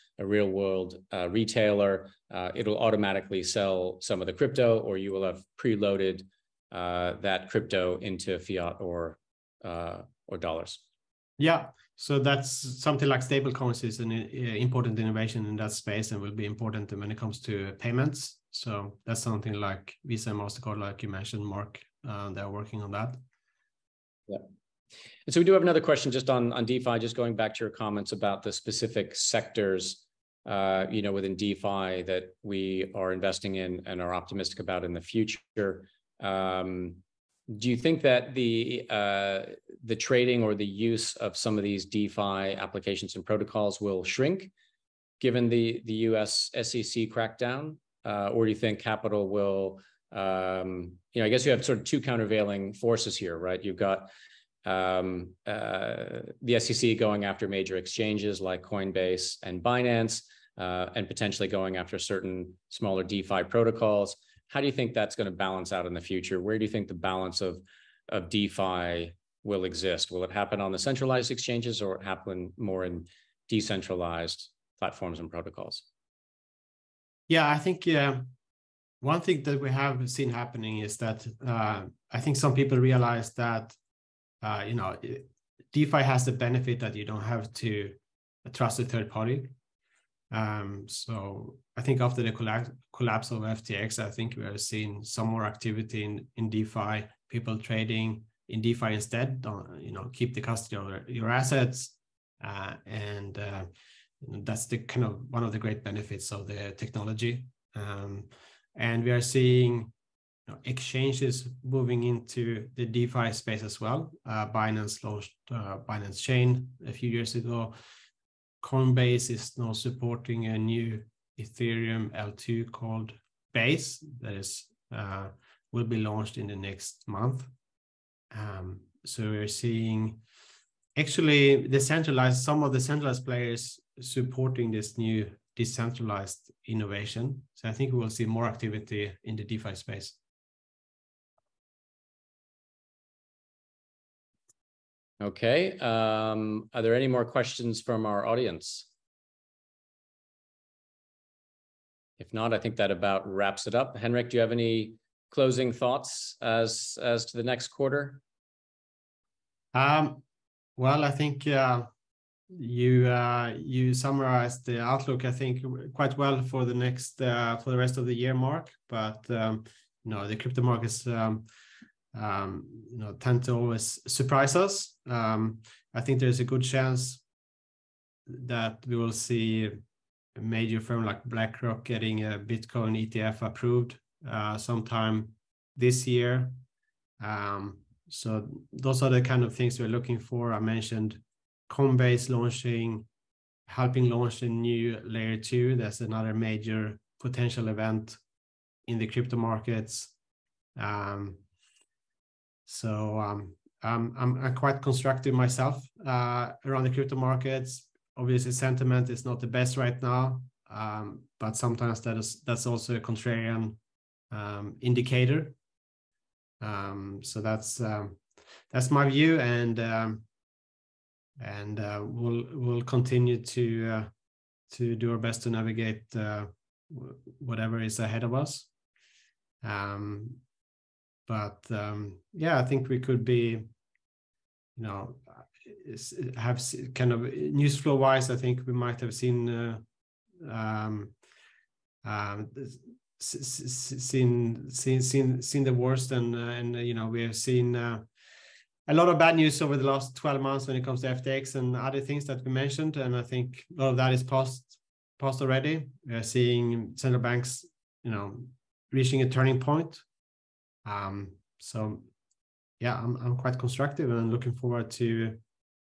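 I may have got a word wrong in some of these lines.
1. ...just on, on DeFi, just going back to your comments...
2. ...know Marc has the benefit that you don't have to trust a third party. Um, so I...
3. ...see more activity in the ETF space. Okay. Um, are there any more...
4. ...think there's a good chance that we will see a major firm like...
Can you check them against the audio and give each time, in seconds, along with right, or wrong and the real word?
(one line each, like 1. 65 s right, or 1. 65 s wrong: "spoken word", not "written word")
1. 26 s right
2. 84 s wrong: "DeFi", not "Marc"
3. 138 s wrong: "DeFi", not "ETF"
4. 176 s right.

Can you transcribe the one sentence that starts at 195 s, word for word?
That's another major potential event in the crypto markets.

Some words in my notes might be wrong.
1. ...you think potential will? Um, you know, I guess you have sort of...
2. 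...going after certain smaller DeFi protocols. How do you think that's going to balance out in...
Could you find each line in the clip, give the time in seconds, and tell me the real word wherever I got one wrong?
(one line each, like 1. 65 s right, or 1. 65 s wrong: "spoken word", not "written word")
1. 48 s wrong: "capital", not "potential"
2. 61 s right.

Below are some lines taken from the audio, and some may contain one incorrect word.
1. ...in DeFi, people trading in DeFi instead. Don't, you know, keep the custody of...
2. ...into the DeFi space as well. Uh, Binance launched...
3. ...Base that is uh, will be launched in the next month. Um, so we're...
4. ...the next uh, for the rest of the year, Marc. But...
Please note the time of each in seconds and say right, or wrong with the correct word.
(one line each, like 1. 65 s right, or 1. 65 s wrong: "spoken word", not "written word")
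1. 96 s right
2. 112 s right
3. 123 s right
4. 166 s right.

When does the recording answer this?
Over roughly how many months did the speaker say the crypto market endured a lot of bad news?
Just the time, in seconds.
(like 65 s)
250 s.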